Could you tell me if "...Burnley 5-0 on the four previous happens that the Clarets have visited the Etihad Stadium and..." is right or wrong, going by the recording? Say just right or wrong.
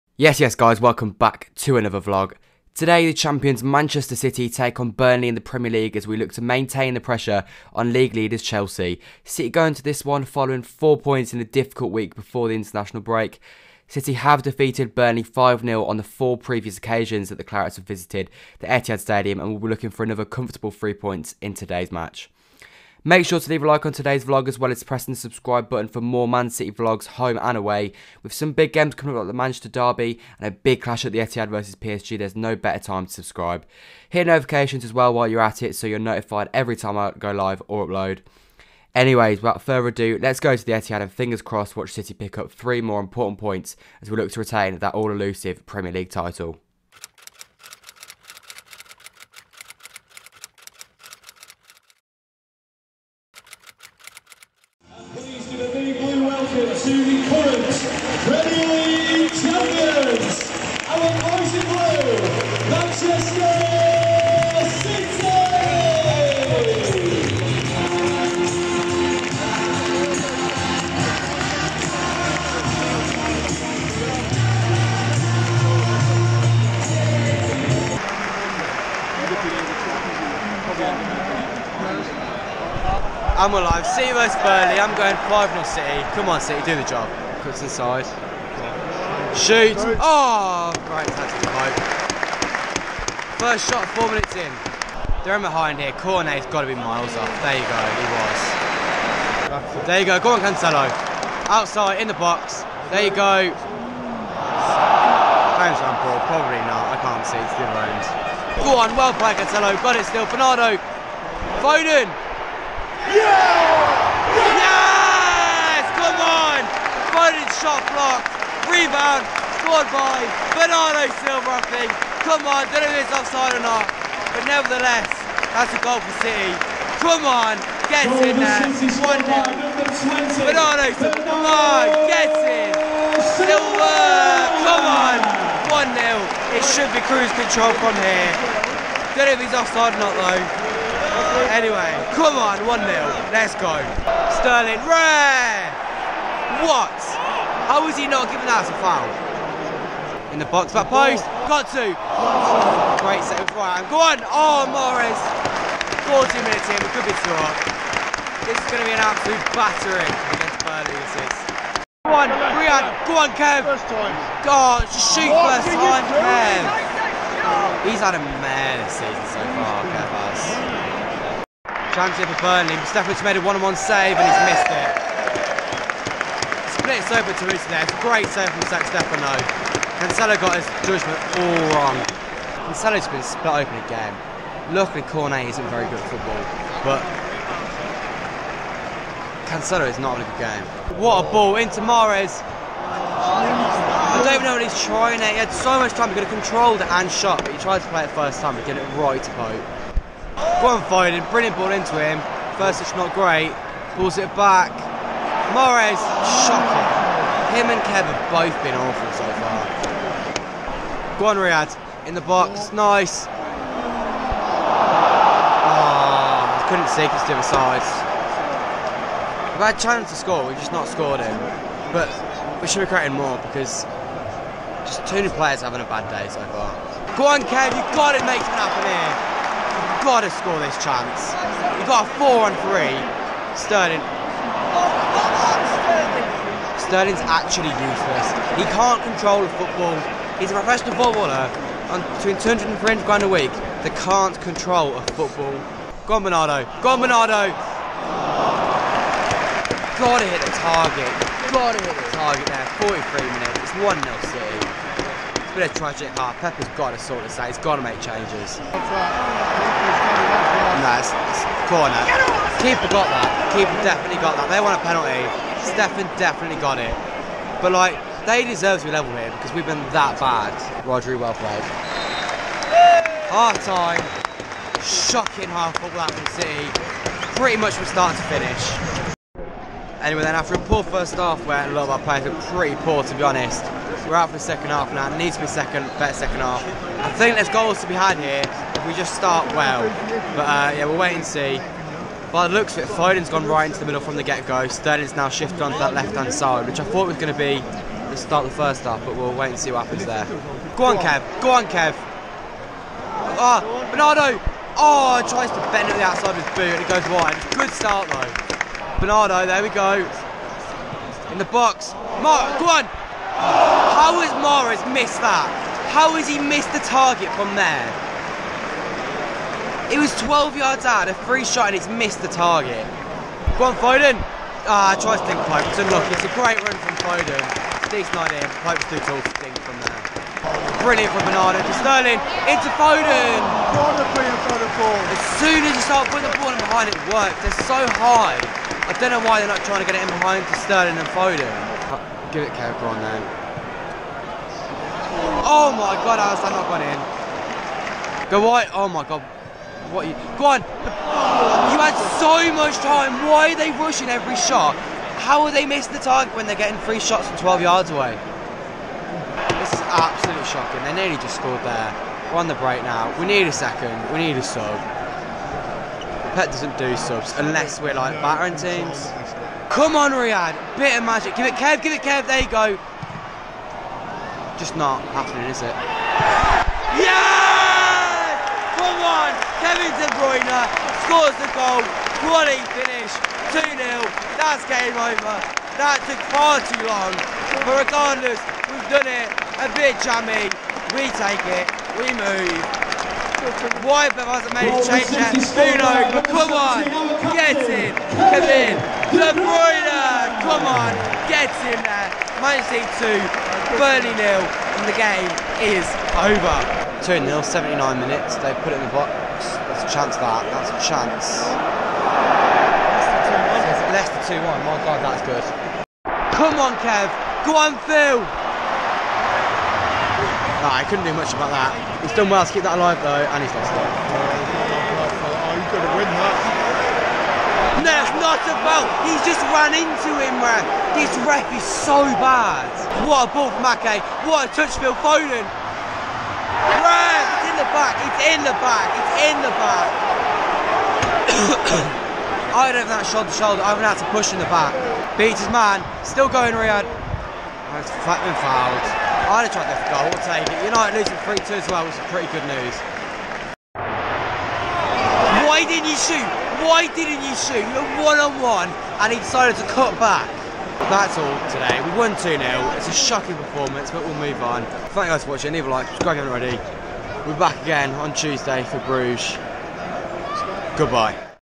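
wrong.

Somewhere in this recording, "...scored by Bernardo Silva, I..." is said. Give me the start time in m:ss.
1:59.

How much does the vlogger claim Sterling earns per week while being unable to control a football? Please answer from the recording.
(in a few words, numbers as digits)
200 to 300 grand.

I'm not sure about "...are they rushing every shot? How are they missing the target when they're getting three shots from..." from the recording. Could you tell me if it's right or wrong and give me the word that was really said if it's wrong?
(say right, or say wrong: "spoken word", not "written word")
right.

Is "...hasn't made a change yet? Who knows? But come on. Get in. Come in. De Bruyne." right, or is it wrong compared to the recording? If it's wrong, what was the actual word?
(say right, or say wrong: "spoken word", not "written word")
right.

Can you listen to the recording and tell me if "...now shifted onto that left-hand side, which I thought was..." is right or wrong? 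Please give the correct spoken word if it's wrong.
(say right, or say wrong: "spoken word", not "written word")
right.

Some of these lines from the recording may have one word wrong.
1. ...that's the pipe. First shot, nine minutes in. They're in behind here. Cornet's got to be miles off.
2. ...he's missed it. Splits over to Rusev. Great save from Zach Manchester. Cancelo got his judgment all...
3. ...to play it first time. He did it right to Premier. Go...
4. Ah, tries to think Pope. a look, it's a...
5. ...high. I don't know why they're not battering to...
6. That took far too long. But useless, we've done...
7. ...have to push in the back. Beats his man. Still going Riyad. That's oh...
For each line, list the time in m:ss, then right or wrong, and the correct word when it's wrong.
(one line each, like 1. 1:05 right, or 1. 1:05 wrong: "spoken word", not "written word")
1. 1:31 wrong: "four", not "nine"
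2. 2:54 wrong: "Stefano", not "Manchester"
3. 3:17 wrong: "Pope", not "Premier"
4. 5:24 right
5. 5:37 wrong: "trying", not "battering"
6. 6:25 wrong: "regardless", not "useless"
7. 7:23 right.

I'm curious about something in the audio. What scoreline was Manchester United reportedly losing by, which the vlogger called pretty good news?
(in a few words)
3-2.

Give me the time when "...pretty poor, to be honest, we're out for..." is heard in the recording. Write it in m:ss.
4:42.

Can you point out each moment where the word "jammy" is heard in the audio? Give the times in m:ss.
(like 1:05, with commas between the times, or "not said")
6:30.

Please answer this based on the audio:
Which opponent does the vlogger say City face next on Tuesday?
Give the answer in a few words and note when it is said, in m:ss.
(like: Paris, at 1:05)
Bruges, at 7:48.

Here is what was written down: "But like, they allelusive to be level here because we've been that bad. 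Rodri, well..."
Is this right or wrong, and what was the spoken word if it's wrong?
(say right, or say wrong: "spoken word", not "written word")
wrong: "deserve", not "allelusive".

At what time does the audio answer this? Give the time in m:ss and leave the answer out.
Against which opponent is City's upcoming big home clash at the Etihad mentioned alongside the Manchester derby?
0:31.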